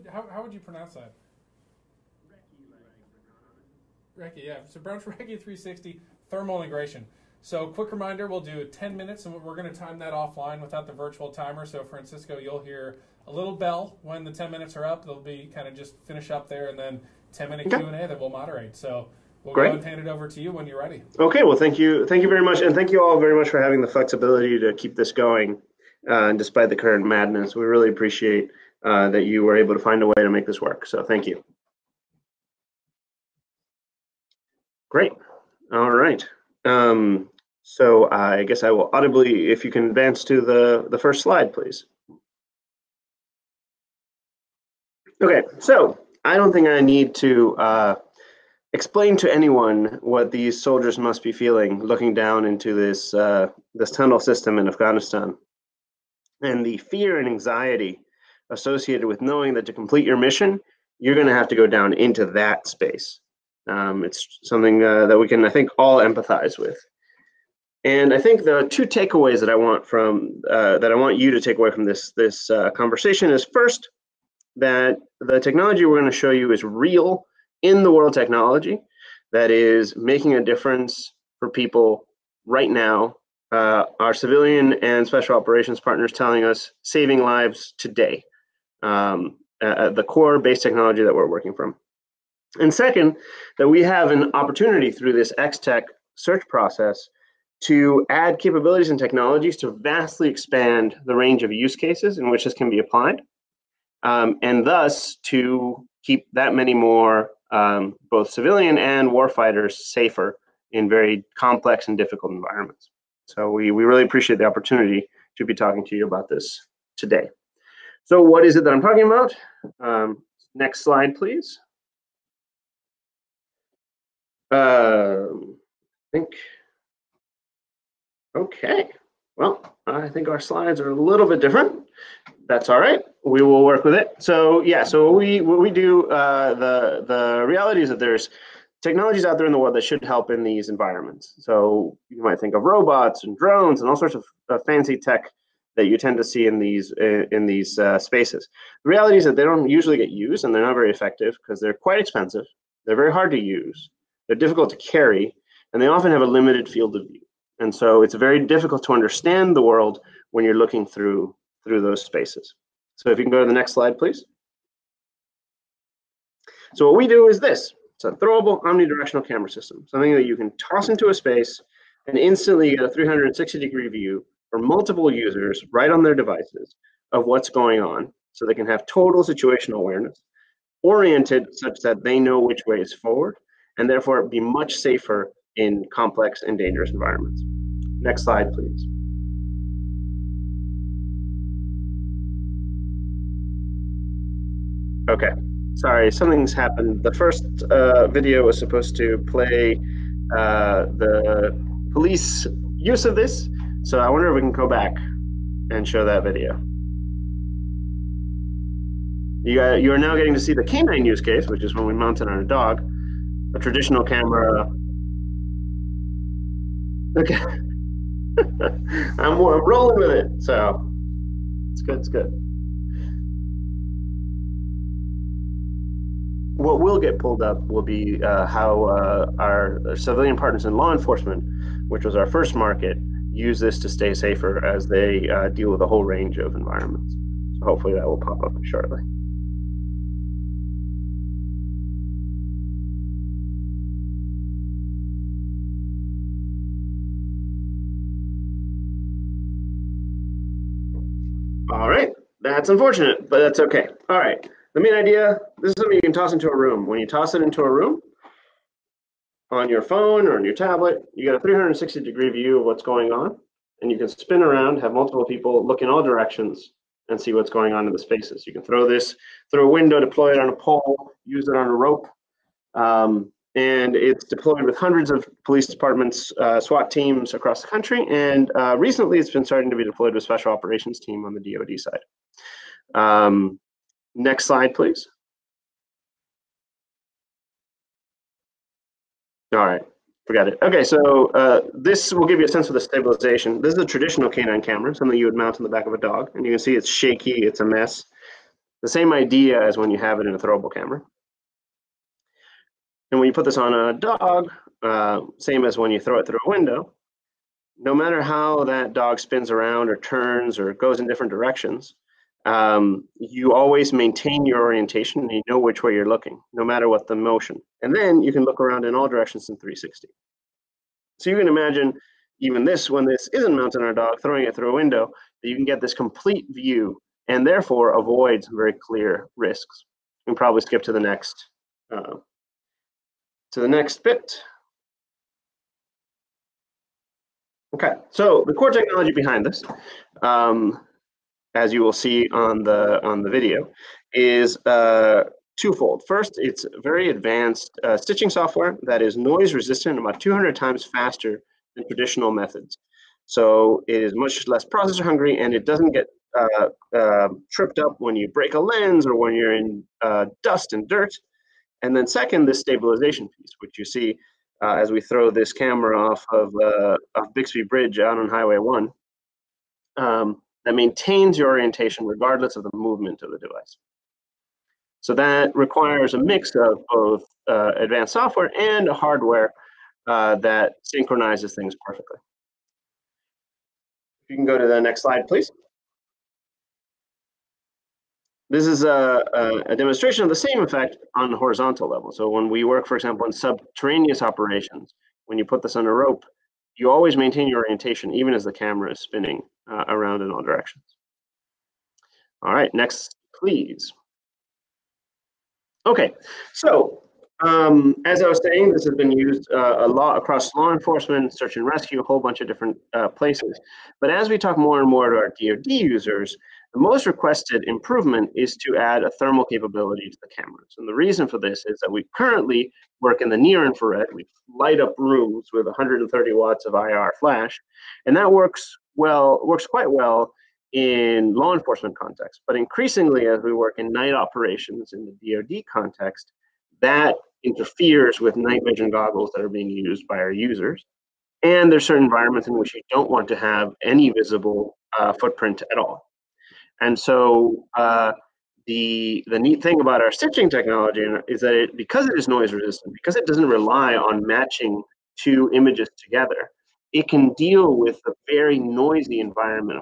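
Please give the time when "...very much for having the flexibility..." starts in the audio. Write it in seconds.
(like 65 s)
23 s.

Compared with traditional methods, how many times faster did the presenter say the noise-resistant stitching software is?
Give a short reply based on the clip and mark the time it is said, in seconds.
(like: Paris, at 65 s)
200 times, at 350 s.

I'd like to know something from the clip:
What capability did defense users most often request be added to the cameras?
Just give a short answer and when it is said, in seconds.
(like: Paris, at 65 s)
thermal capability, at 419 s.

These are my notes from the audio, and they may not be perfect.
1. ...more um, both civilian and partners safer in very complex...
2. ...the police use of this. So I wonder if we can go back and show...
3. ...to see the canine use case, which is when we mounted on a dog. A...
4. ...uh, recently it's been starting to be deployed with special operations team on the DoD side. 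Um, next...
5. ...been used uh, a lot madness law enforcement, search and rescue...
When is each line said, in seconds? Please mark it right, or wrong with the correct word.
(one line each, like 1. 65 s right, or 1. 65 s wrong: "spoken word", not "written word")
1. 106 s wrong: "warfighters", not "partners"
2. 200 s right
3. 210 s right
4. 278 s right
5. 408 s wrong: "across", not "madness".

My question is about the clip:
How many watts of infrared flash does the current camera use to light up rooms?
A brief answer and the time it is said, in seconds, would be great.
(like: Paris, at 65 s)
130 watts, at 425 s.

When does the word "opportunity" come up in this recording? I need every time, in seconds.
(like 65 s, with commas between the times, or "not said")
94 s, 114 s.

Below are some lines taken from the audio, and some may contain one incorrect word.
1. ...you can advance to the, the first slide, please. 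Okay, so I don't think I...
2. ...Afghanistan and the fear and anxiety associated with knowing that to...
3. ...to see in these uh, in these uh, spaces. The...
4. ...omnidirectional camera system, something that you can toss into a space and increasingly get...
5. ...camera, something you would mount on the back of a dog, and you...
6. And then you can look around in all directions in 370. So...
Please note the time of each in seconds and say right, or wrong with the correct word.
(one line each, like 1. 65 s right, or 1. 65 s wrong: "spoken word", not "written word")
1. 39 s right
2. 54 s right
3. 146 s right
4. 168 s wrong: "instantly", not "increasingly"
5. 294 s right
6. 317 s wrong: "360", not "370".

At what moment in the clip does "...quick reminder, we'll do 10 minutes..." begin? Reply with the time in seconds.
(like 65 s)
7 s.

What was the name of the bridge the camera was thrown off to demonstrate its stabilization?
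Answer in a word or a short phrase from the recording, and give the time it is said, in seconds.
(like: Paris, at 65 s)
Bixby Bridge, at 367 s.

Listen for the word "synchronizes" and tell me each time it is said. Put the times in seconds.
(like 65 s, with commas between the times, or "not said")
380 s.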